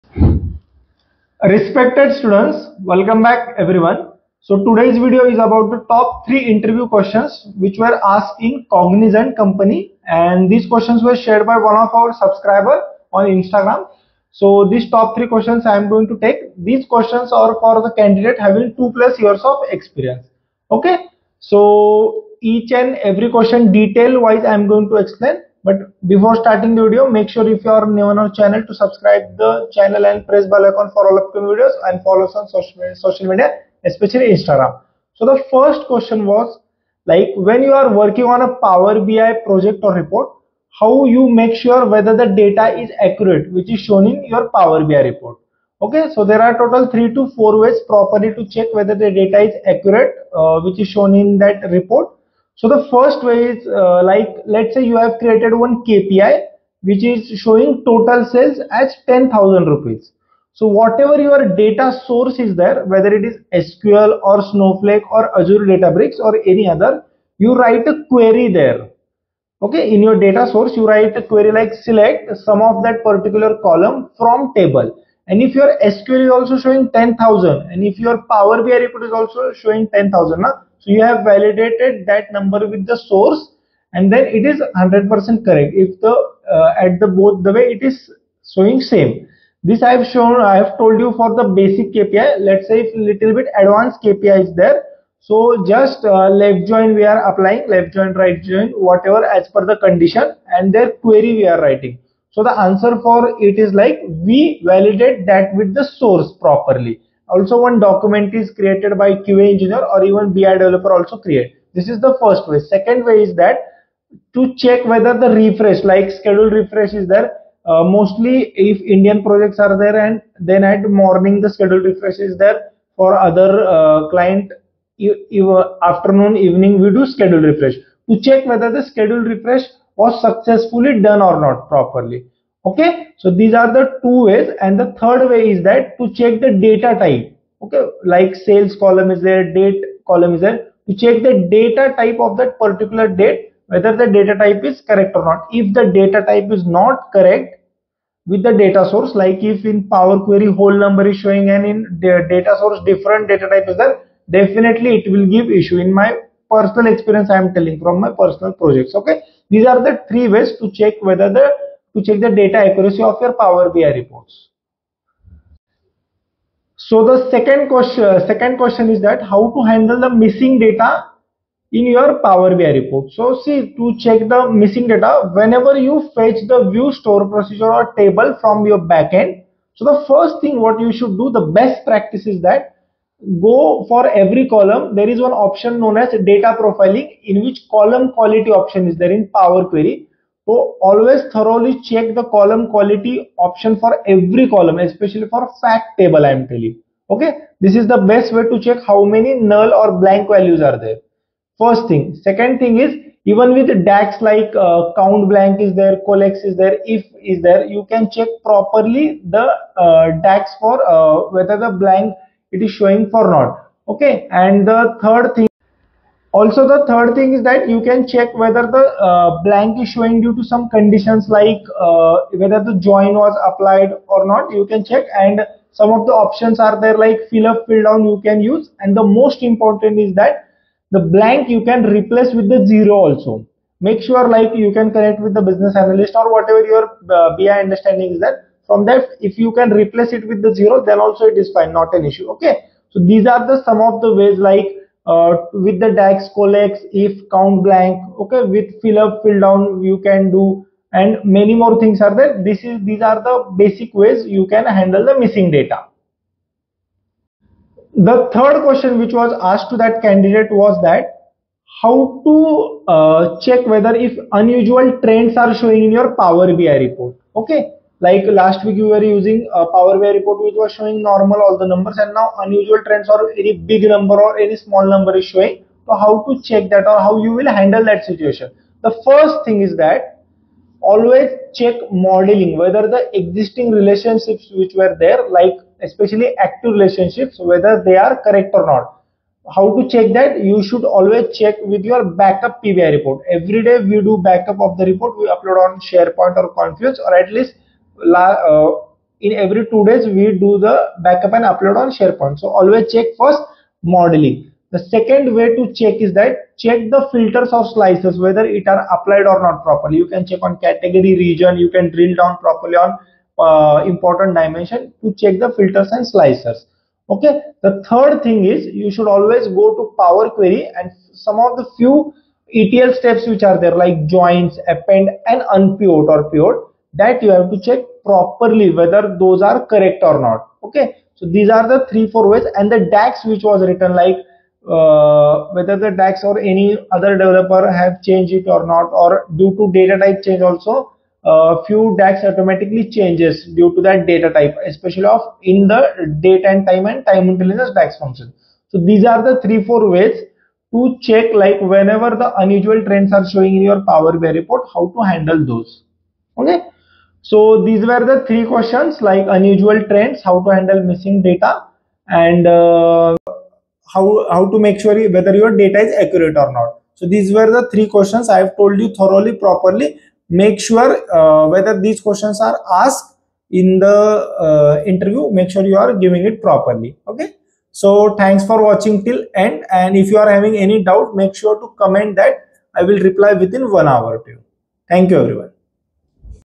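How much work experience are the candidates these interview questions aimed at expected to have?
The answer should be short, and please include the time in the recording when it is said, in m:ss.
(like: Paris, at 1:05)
2+ years, at 0:18.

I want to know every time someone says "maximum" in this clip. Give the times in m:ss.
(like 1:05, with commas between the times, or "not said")
not said.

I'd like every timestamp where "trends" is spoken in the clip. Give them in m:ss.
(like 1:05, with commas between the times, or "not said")
4:25, 4:32, 5:52, 5:59.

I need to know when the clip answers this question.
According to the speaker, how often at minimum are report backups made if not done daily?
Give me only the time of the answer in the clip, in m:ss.
4:59.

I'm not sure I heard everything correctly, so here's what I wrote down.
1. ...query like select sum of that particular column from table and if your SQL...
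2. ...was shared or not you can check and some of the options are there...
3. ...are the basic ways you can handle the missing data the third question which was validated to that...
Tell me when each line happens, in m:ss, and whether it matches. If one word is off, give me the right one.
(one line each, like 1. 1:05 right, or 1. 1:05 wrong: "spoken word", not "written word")
1. 1:11 right
2. 3:43 wrong: "applied", not "shared"
3. 4:13 wrong: "asked", not "validated".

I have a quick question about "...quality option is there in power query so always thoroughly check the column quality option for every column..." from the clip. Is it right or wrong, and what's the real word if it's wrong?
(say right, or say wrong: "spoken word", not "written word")
right.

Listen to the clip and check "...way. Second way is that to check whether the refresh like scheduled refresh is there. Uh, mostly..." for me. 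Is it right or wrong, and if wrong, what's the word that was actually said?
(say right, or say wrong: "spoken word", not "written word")
right.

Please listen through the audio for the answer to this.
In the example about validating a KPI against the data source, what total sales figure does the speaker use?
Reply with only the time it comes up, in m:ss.
0:59.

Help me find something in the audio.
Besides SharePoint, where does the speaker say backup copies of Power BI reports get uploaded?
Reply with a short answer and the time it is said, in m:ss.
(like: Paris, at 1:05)
Confluence, at 4:56.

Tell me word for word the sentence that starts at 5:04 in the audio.
The second way to check is that check the filters or slicers whether it are applied or not properly.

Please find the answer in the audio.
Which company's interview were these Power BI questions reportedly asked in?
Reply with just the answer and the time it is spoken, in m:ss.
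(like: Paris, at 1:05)
Cognizant, at 0:08.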